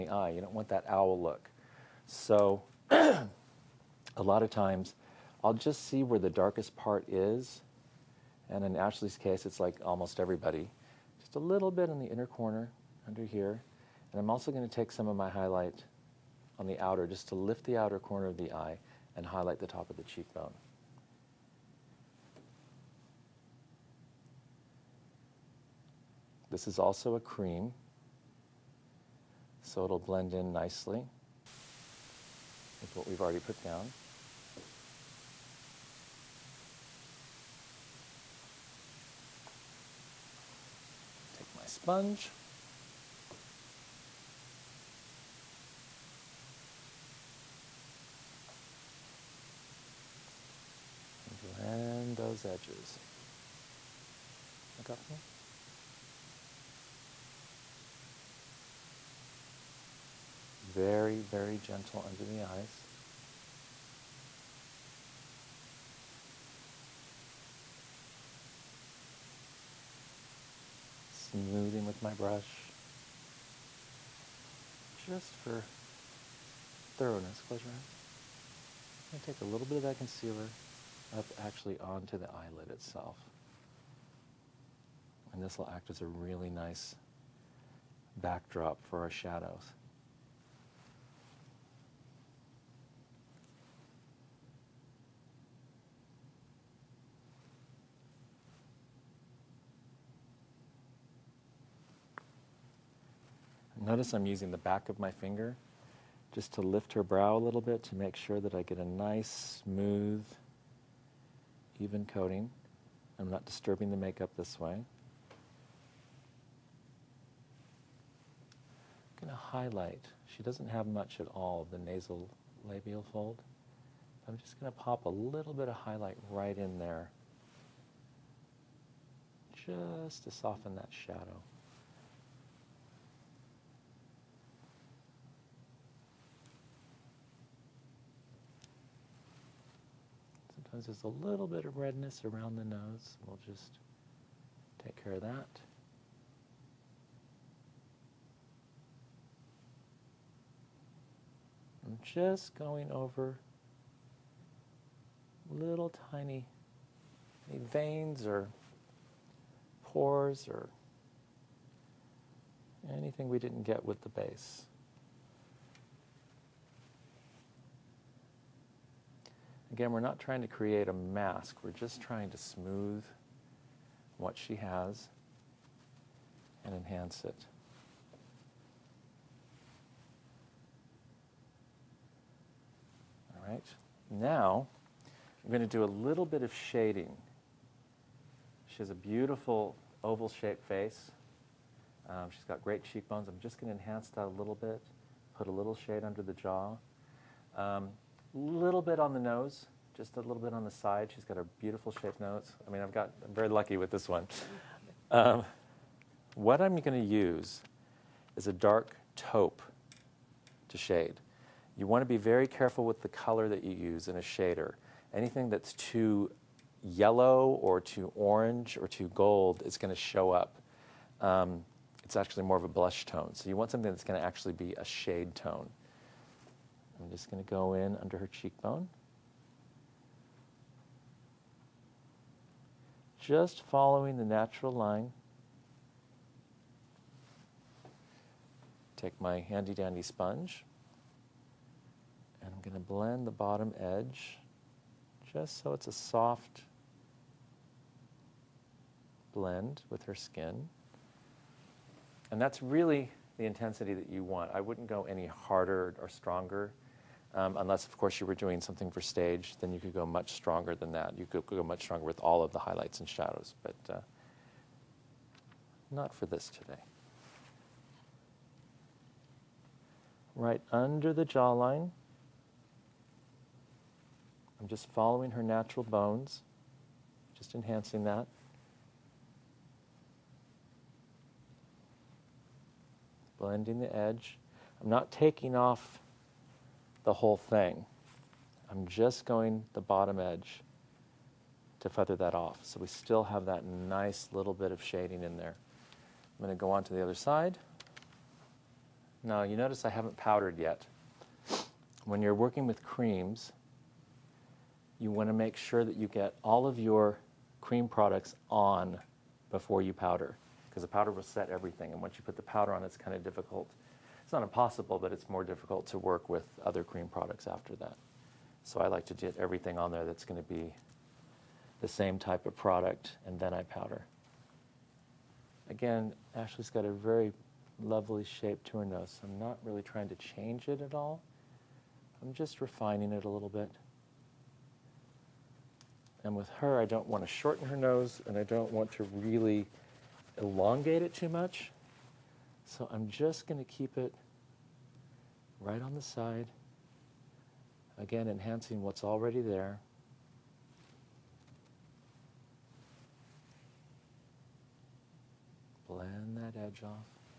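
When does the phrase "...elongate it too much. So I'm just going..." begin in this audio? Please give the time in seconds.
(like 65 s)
340 s.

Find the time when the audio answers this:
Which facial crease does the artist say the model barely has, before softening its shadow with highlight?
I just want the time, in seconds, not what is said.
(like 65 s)
121 s.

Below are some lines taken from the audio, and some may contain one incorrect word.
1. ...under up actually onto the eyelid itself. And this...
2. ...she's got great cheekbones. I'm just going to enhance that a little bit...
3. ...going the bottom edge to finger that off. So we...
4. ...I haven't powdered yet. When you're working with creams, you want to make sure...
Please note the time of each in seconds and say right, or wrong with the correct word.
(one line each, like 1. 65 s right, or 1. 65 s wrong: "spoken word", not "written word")
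1. 79 s wrong: "concealer", not "under"
2. 192 s right
3. 289 s wrong: "feather", not "finger"
4. 299 s right.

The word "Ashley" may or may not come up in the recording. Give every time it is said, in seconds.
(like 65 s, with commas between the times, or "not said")
8 s, 326 s.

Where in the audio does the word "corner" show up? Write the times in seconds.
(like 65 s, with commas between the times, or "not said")
12 s, 17 s.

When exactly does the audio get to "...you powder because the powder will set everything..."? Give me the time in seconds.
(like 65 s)
309 s.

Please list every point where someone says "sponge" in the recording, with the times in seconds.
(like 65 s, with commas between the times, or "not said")
41 s, 240 s.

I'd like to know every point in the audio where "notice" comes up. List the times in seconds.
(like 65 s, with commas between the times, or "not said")
103 s, 299 s.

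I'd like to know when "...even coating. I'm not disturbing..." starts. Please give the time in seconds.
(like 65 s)
111 s.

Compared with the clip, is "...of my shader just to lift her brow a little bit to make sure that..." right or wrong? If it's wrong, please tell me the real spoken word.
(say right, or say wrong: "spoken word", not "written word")
wrong: "finger", not "shader".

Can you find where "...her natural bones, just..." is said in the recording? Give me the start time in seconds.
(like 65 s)
275 s.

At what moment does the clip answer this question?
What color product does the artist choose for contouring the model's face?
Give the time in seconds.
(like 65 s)
208 s.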